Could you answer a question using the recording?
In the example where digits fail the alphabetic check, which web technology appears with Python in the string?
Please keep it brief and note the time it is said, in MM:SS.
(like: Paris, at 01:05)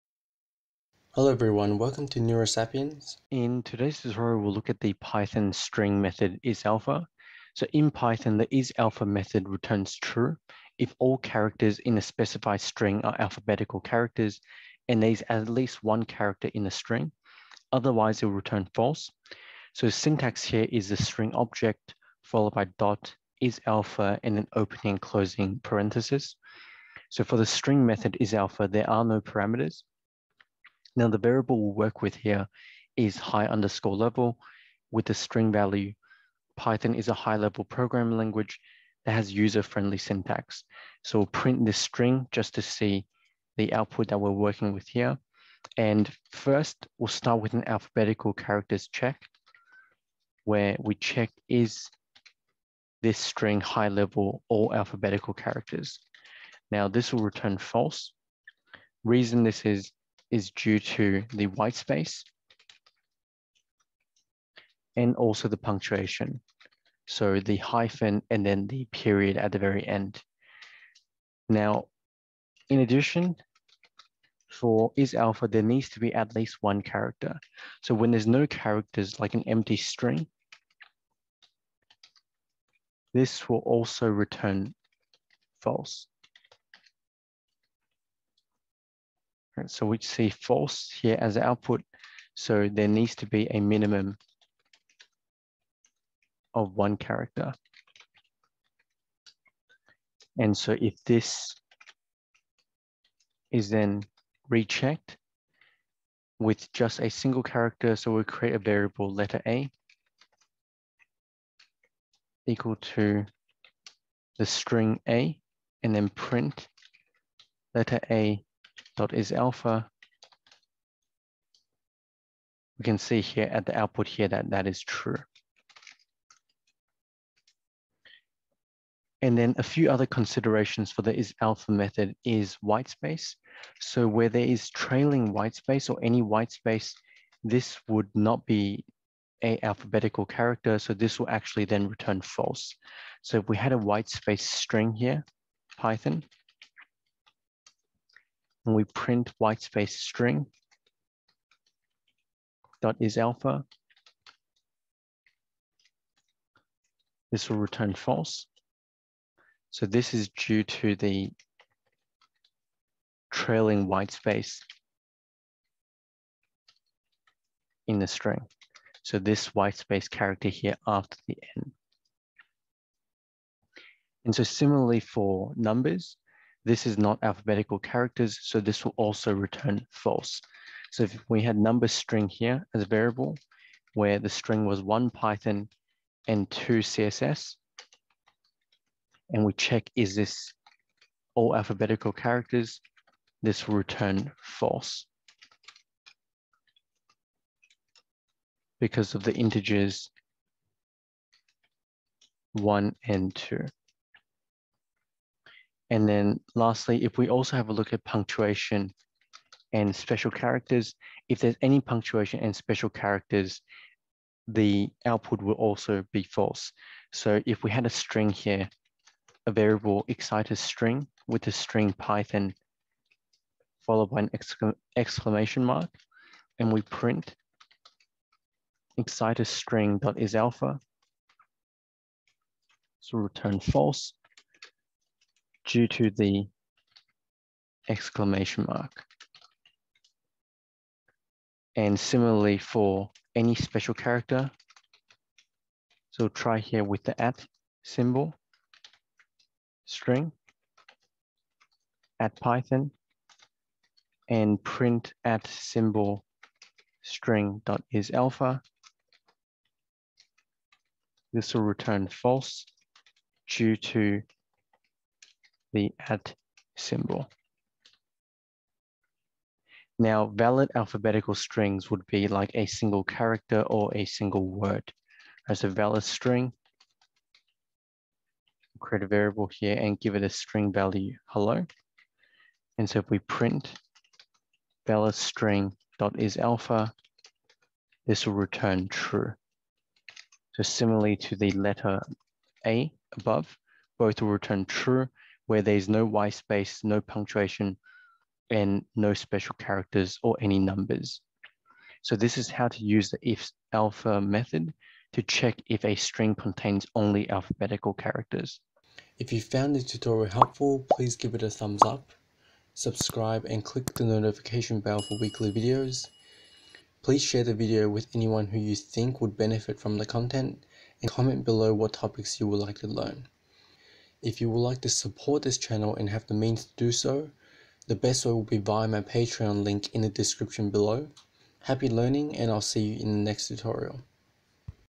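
CSS, at 03:06.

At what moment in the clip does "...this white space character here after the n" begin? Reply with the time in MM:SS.
02:49.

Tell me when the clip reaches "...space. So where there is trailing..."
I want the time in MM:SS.
02:12.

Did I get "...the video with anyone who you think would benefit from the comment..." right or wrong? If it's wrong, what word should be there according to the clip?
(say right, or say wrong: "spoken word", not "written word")
wrong: "content", not "comment".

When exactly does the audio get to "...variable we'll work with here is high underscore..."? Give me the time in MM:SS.
00:31.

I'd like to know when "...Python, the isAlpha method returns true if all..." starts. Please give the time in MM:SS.
00:07.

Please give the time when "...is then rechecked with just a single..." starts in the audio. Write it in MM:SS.
01:43.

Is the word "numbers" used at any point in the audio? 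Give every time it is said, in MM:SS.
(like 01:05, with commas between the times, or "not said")
02:55, 03:01, 05:00.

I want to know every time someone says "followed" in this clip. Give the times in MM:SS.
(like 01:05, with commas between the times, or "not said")
00:22, 03:43.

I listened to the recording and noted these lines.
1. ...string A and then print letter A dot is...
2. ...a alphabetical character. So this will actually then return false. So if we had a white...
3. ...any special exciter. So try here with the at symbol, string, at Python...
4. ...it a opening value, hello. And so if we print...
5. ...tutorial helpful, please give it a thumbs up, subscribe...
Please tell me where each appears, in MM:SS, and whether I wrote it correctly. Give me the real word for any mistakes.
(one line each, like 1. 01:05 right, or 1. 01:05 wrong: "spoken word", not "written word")
1. 01:54 right
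2. 02:19 right
3. 04:03 wrong: "character", not "exciter"
4. 04:40 wrong: "string", not "opening"
5. 05:09 right.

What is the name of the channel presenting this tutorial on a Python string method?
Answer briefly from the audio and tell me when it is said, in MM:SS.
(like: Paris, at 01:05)
NeuraSapiens, at 00:02.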